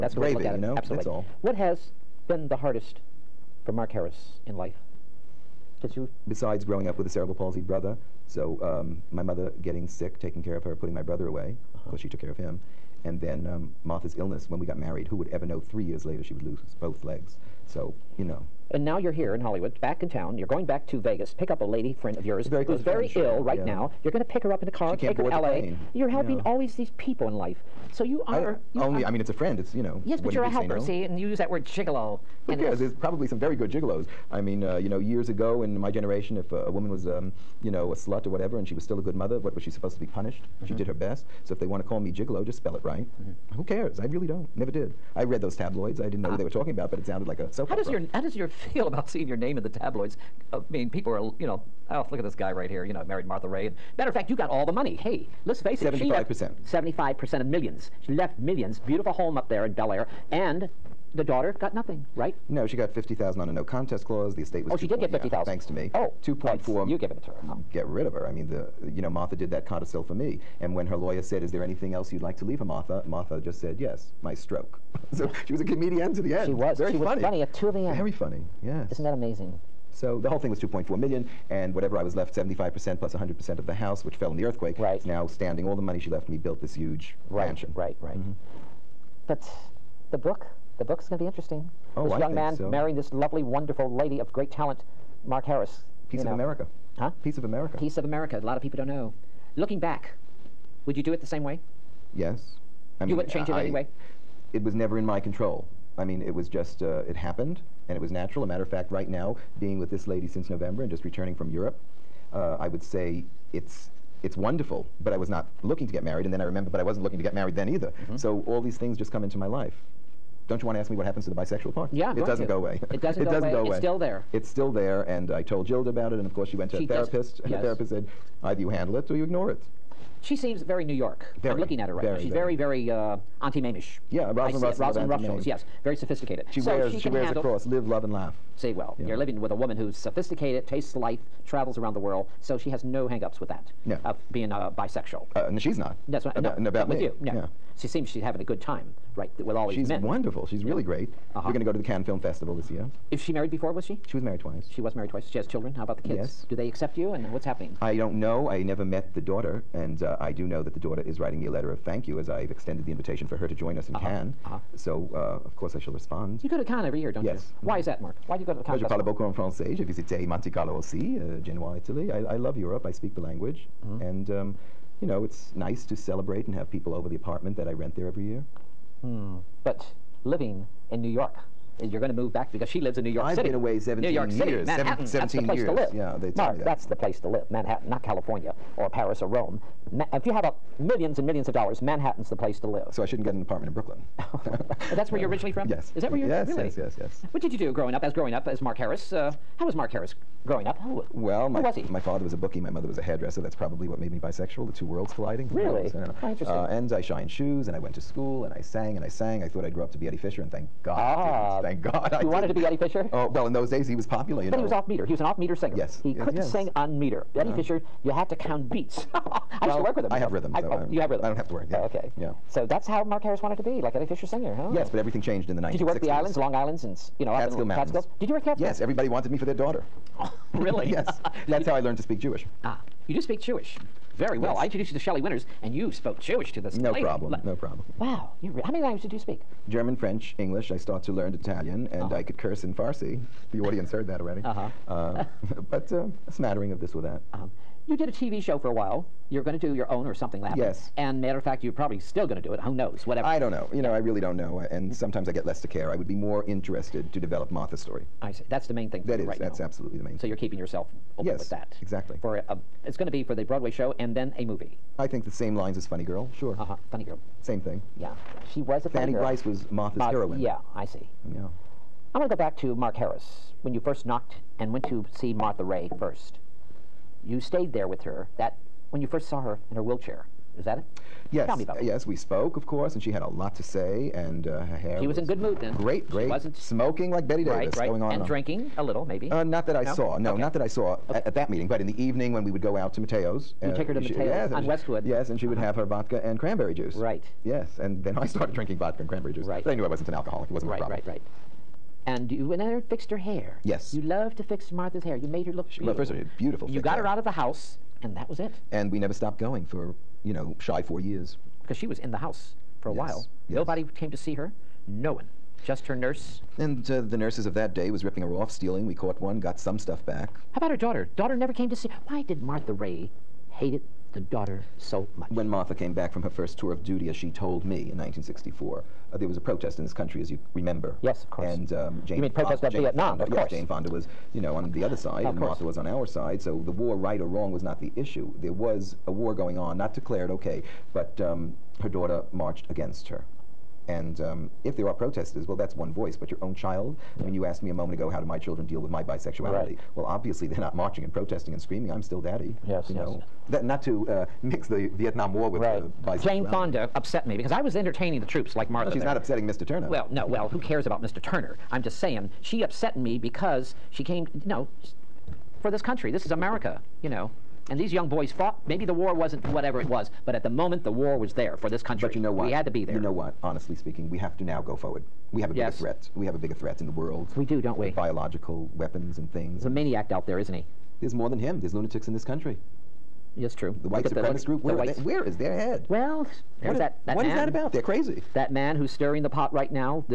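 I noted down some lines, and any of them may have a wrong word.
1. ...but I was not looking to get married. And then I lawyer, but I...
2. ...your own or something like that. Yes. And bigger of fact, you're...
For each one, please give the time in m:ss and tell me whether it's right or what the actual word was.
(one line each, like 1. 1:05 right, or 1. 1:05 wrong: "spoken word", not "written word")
1. 1:55 wrong: "remember", not "lawyer"
2. 4:09 wrong: "matter", not "bigger".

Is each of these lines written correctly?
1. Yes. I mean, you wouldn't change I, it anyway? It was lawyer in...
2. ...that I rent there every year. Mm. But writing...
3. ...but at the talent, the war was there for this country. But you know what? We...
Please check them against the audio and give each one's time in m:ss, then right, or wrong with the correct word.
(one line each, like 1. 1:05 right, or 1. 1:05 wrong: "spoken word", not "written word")
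1. 1:42 wrong: "never", not "lawyer"
2. 2:57 wrong: "living", not "writing"
3. 6:10 wrong: "moment", not "talent".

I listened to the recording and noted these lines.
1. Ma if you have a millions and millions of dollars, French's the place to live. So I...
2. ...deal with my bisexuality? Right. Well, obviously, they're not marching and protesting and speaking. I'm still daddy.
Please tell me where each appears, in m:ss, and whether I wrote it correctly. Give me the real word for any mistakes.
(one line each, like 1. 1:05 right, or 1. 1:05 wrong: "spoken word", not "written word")
1. 3:09 wrong: "Manhattan", not "French"
2. 5:48 wrong: "screaming", not "speaking".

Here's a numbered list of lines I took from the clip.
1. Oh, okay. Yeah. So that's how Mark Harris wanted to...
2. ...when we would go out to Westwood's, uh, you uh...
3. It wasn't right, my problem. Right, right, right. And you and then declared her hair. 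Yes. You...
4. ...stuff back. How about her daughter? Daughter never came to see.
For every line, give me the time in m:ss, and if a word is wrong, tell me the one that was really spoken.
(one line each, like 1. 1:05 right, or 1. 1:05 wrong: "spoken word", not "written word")
1. 3:41 right
2. 4:52 wrong: "Matteo", not "Westwood"
3. 5:00 wrong: "fixed", not "declared"
4. 5:19 right.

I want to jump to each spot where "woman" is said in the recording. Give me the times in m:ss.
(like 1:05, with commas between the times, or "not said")
0:36, 2:19.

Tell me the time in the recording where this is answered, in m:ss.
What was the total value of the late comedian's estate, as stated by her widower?
1:20.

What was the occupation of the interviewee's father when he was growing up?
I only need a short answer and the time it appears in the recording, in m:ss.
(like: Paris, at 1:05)
Bookie, at 3:22.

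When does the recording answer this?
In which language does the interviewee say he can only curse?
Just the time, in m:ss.
4:02.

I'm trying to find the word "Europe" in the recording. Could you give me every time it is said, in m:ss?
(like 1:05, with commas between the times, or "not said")
1:51, 2:52.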